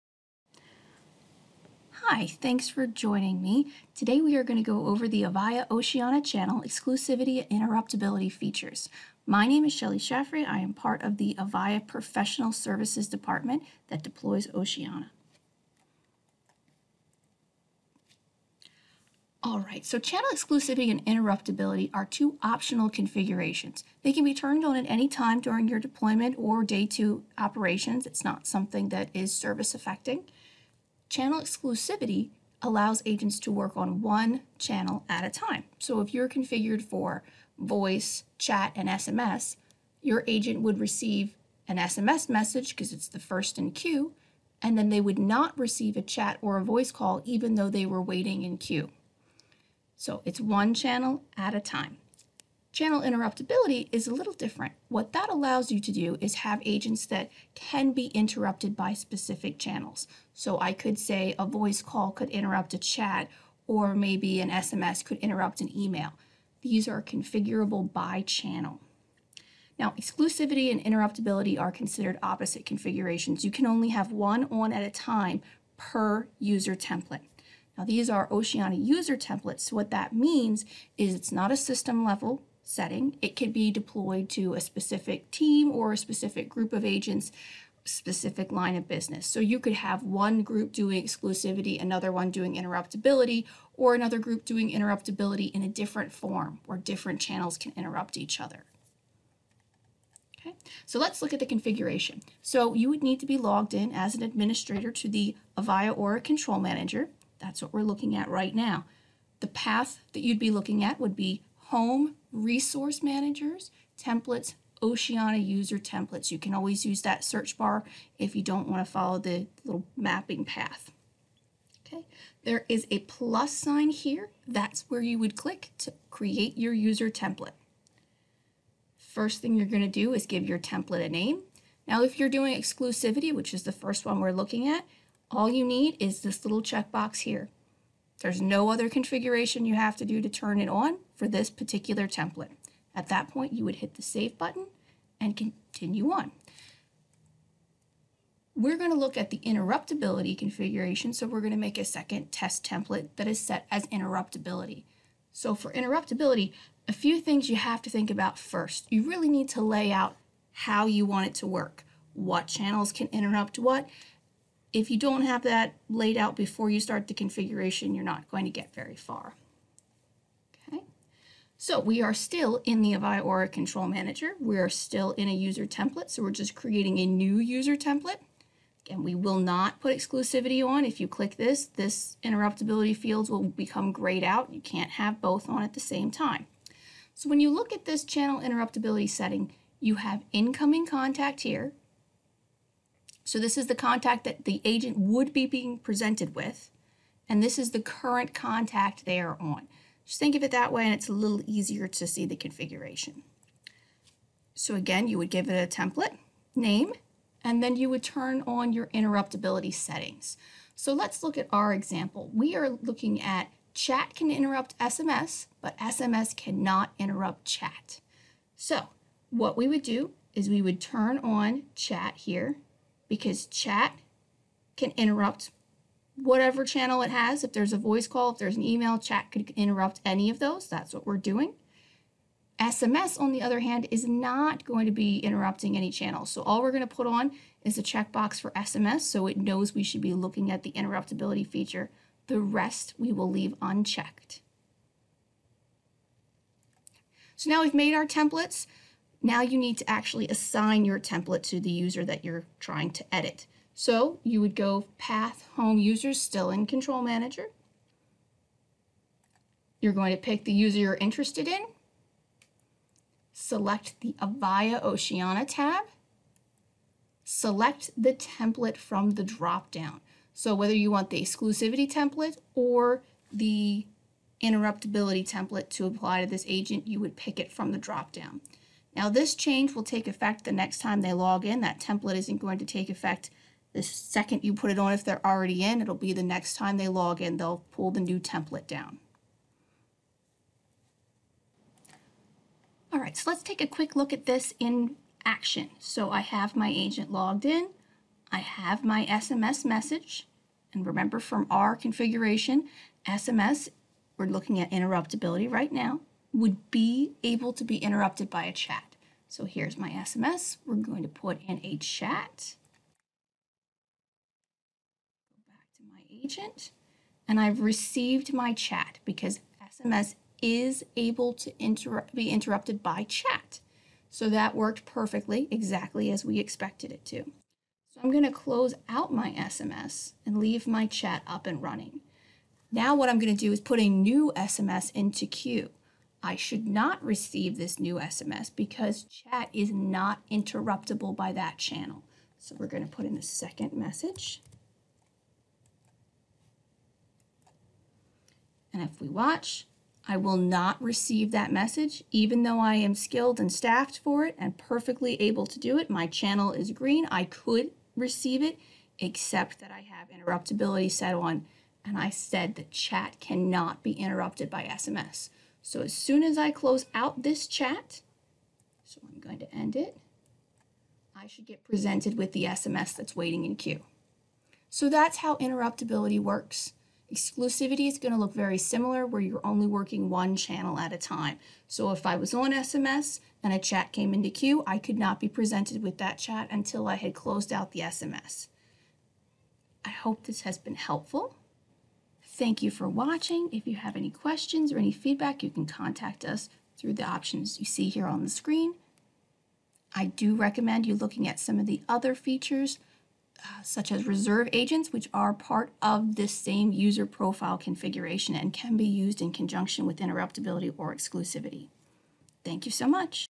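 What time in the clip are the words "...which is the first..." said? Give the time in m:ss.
2:13.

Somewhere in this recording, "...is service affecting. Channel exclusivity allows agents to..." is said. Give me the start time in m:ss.
0:29.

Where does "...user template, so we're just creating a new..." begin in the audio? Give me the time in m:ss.
2:55.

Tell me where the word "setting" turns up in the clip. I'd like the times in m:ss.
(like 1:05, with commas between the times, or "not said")
1:22, 3:09, 3:29.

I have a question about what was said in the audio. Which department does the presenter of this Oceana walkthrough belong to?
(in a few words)
Avaya Professional Services.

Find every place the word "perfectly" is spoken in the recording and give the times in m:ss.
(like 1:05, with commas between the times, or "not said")
5:24, 5:54.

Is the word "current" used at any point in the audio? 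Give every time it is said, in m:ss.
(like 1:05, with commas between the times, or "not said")
3:17.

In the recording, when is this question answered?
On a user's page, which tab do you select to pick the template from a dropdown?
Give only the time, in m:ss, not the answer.
4:24.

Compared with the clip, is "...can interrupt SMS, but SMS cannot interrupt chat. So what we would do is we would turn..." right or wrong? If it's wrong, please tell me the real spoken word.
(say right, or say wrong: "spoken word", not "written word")
right.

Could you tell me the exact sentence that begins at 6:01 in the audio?
And I said that chat cannot be interrupted by SMS.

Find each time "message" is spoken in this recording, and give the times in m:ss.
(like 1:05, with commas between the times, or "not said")
0:42, 4:59, 5:43, 5:51.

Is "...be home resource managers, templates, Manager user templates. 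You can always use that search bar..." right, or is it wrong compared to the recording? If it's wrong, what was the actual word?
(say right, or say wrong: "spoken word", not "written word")
wrong: "Oceana", not "Manager".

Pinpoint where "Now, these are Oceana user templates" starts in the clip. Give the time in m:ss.
1:17.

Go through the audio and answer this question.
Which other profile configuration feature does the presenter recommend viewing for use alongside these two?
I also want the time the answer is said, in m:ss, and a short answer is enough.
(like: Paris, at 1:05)
reserve agents, at 6:44.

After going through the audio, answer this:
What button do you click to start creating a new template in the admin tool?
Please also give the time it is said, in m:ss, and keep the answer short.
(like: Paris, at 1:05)
plus sign, at 2:02.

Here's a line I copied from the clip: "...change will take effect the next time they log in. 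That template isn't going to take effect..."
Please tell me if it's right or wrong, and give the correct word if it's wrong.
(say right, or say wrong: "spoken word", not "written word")
right.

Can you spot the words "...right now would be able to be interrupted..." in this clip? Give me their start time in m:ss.
5:05.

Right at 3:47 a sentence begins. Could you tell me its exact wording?
If there's a voice call, if there's an email, chat could interrupt any of those.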